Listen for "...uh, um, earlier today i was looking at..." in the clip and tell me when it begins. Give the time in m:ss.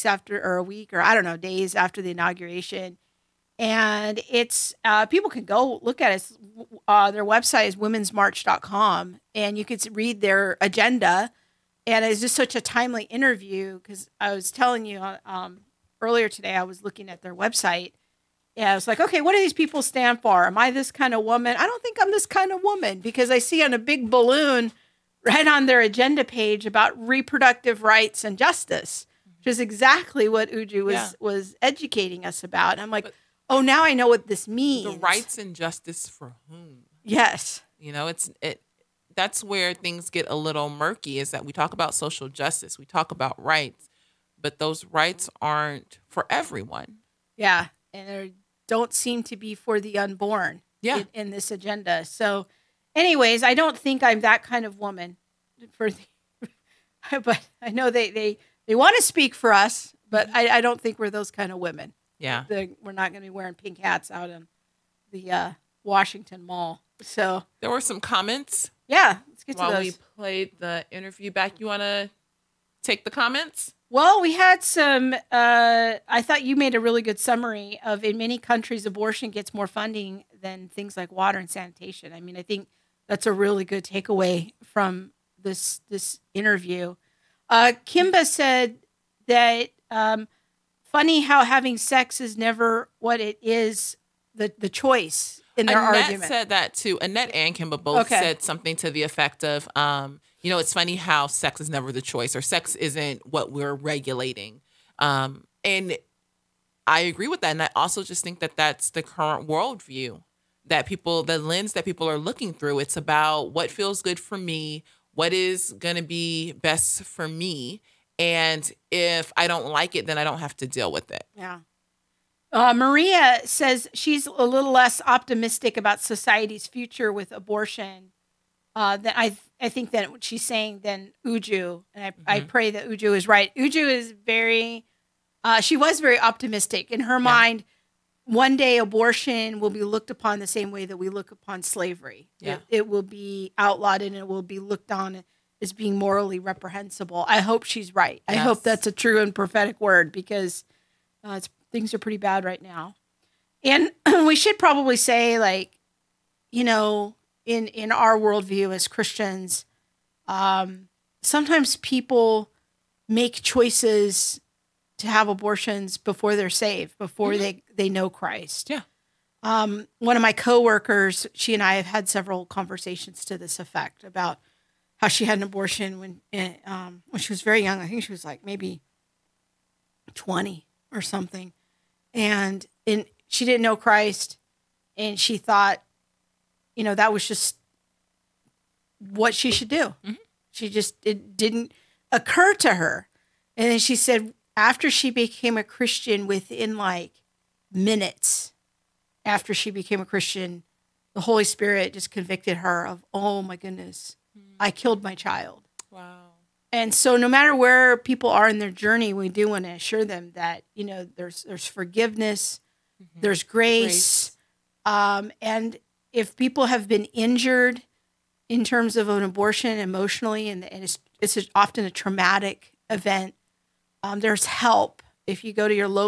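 0:14.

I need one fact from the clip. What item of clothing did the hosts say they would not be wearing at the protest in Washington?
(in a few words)
pink hats.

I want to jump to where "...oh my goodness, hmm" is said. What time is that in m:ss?
3:23.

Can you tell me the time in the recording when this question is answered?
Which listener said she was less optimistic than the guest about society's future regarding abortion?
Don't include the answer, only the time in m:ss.
2:02.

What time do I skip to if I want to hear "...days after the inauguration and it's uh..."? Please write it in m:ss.
0:01.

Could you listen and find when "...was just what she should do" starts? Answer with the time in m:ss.
3:07.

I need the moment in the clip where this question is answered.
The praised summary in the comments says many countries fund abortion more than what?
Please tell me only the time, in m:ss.
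1:21.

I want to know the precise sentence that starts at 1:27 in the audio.
Uh, Kimba said that um, funny how having sex is never what it is the the choice in their Annette argument.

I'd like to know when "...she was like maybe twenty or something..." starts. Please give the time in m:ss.
2:58.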